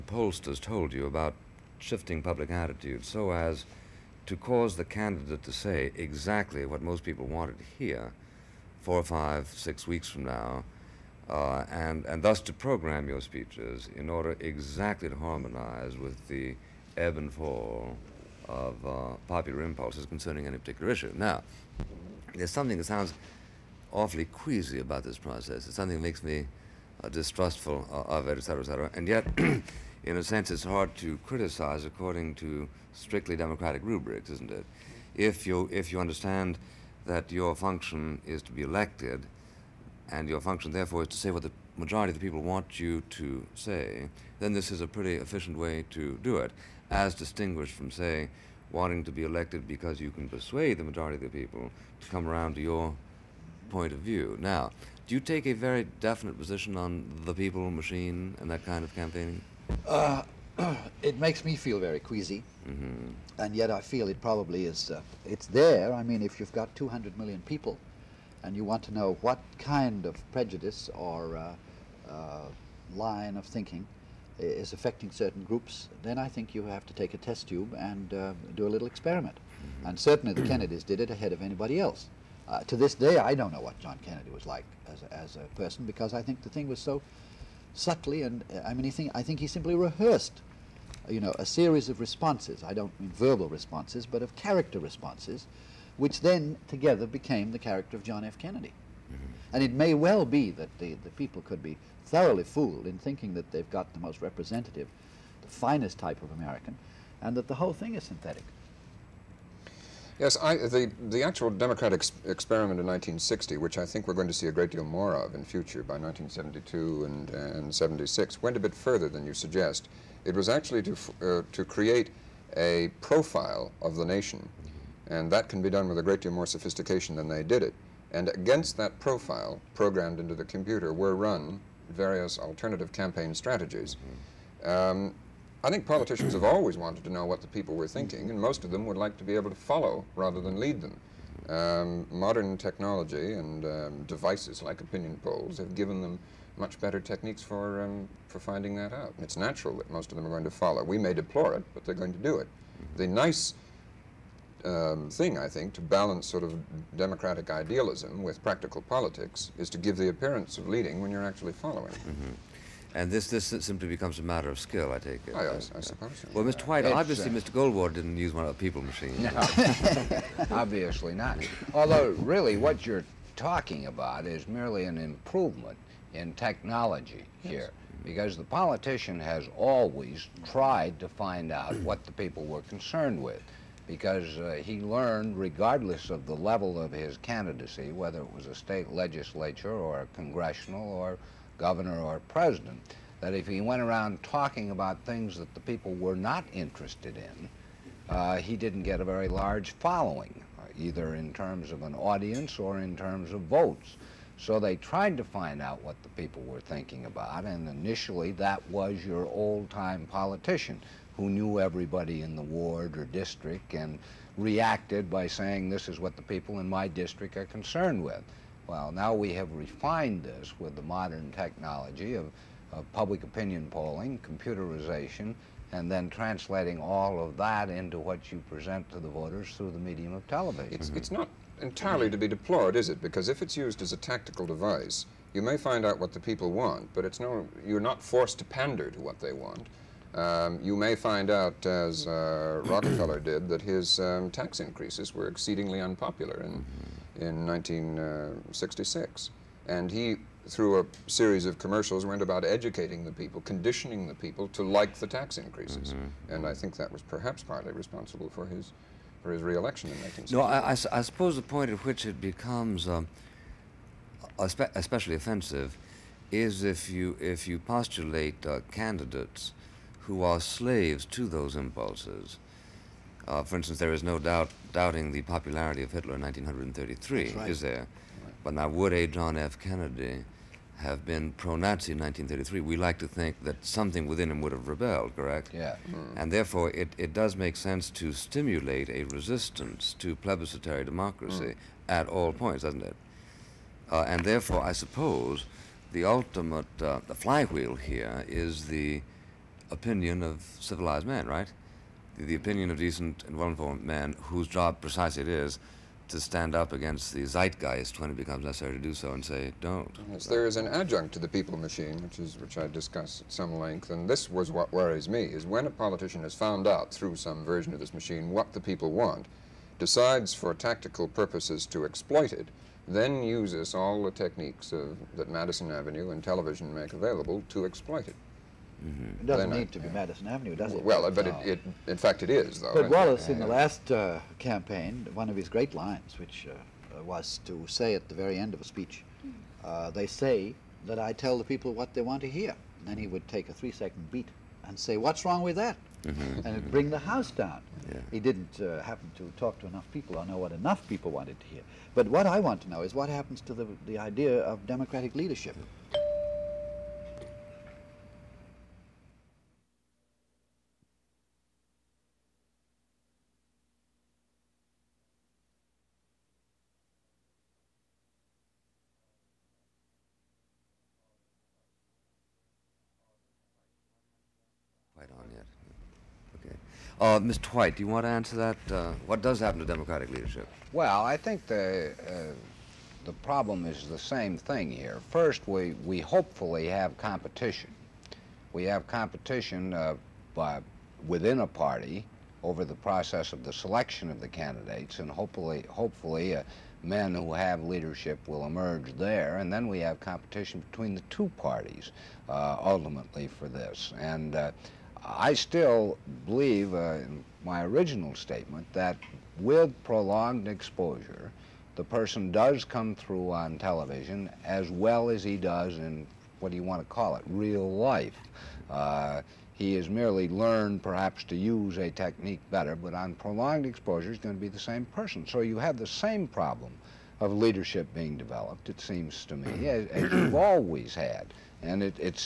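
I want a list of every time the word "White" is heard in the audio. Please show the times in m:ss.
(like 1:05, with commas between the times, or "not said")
2:46, 6:17.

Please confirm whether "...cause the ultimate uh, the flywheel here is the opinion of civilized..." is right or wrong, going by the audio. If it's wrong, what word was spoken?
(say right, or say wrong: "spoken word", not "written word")
wrong: "suppose", not "cause".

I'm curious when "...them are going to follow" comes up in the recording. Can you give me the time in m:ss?
2:30.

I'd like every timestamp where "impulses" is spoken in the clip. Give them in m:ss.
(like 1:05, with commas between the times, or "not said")
0:19, 4:31.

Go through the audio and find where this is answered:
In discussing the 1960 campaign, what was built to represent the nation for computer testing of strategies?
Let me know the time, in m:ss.
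2:02.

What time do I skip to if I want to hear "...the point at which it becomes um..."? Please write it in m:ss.
4:21.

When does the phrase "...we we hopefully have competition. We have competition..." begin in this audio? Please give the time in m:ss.
6:25.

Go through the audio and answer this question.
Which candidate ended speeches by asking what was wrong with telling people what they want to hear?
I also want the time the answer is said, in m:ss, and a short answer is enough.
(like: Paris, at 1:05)
Wallace, at 5:32.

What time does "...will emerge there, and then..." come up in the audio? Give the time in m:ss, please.
6:38.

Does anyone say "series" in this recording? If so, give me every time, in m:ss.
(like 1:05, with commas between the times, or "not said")
1:31, 4:11.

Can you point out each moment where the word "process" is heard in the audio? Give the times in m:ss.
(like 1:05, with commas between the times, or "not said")
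0:25, 6:32.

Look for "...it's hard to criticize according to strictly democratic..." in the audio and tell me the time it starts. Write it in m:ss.
0:30.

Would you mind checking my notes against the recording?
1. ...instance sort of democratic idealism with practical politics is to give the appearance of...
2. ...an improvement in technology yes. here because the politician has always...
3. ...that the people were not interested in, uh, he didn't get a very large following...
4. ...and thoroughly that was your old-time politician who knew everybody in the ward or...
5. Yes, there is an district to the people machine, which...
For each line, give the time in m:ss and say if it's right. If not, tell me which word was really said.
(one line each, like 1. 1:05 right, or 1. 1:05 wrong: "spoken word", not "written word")
1. 2:35 wrong: "balance", not "instance"
2. 2:54 right
3. 3:15 right
4. 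3:27 wrong: "initially", not "thoroughly"
5. 5:10 wrong: "adjunct", not "district".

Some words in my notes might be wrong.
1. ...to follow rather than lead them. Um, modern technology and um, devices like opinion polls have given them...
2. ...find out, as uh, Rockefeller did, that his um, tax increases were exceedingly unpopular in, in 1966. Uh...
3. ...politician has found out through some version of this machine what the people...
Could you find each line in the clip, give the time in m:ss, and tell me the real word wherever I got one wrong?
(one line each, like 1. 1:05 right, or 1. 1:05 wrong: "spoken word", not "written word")
1. 2:19 right
2. 4:00 right
3. 5:15 right.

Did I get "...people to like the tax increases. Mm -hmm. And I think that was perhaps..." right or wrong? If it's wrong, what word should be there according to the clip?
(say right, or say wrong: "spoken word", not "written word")
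right.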